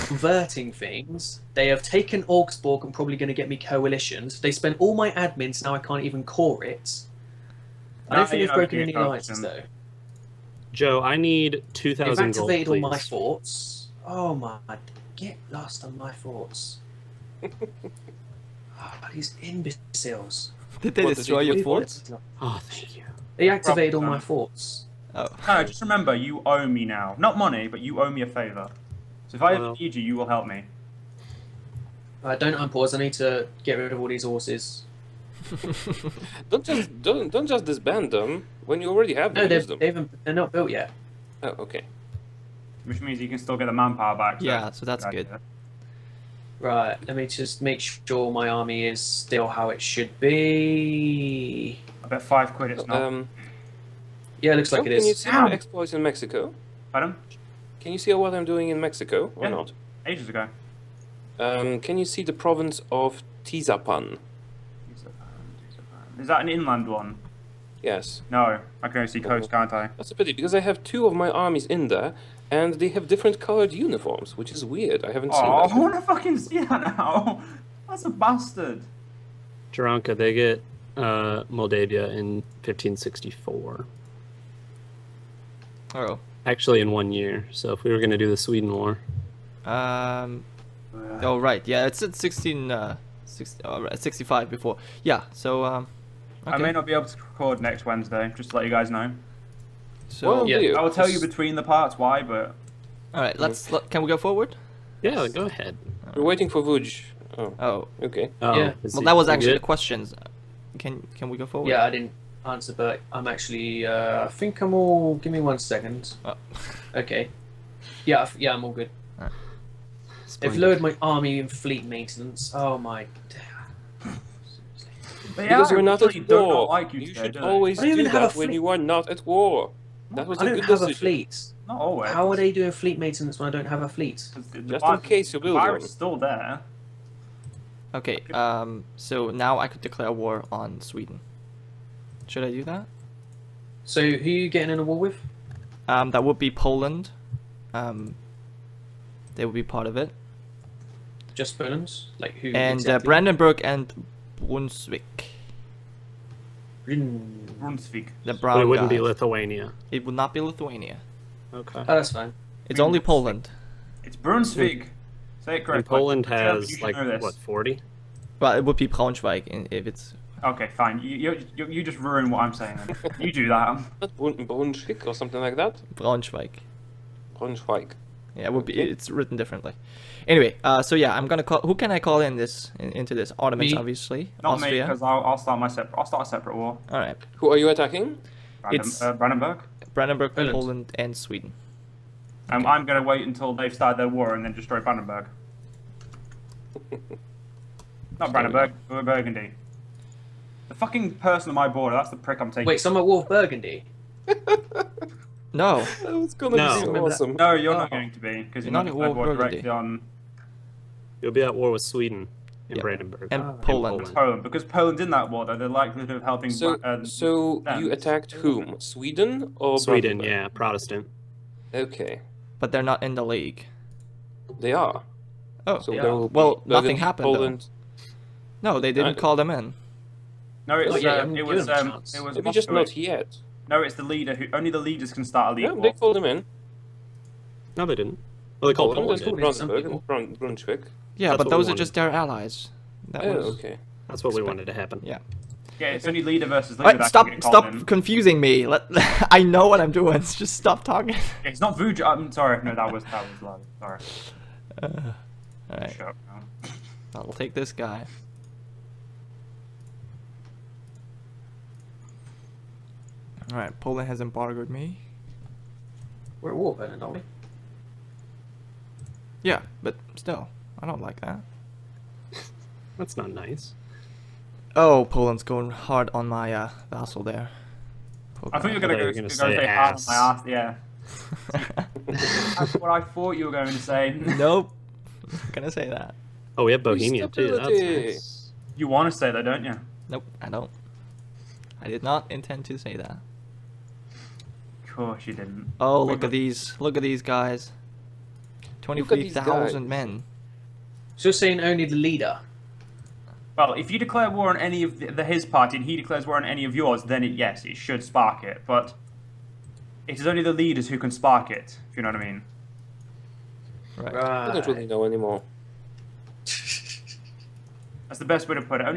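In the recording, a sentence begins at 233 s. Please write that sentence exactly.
No, it's the leader who only the leaders can start a league.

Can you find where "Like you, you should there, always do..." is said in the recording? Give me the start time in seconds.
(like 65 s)
126 s.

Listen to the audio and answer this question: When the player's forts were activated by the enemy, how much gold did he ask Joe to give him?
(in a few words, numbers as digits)
2,000.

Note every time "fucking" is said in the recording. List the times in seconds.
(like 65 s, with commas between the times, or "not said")
76 s, 200 s.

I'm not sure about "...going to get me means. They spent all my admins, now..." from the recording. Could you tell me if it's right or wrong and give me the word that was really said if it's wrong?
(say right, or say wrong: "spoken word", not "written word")
wrong: "coalitions", not "means".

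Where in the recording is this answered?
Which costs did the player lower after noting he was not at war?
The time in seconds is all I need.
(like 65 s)
121 s.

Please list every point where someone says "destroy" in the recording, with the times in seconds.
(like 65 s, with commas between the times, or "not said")
21 s, 194 s.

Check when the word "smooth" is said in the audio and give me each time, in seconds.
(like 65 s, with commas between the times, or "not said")
not said.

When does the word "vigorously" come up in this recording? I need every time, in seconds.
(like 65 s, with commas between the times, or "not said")
not said.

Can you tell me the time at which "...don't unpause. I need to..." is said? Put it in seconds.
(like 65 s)
32 s.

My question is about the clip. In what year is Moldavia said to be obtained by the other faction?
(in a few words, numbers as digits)
1564.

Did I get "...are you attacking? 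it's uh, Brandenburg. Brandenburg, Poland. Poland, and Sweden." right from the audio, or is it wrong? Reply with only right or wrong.
right.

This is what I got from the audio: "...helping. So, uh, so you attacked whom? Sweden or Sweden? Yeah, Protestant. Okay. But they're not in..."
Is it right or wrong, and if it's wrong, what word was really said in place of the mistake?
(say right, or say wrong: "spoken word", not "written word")
right.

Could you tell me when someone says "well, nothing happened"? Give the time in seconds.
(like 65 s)
226 s.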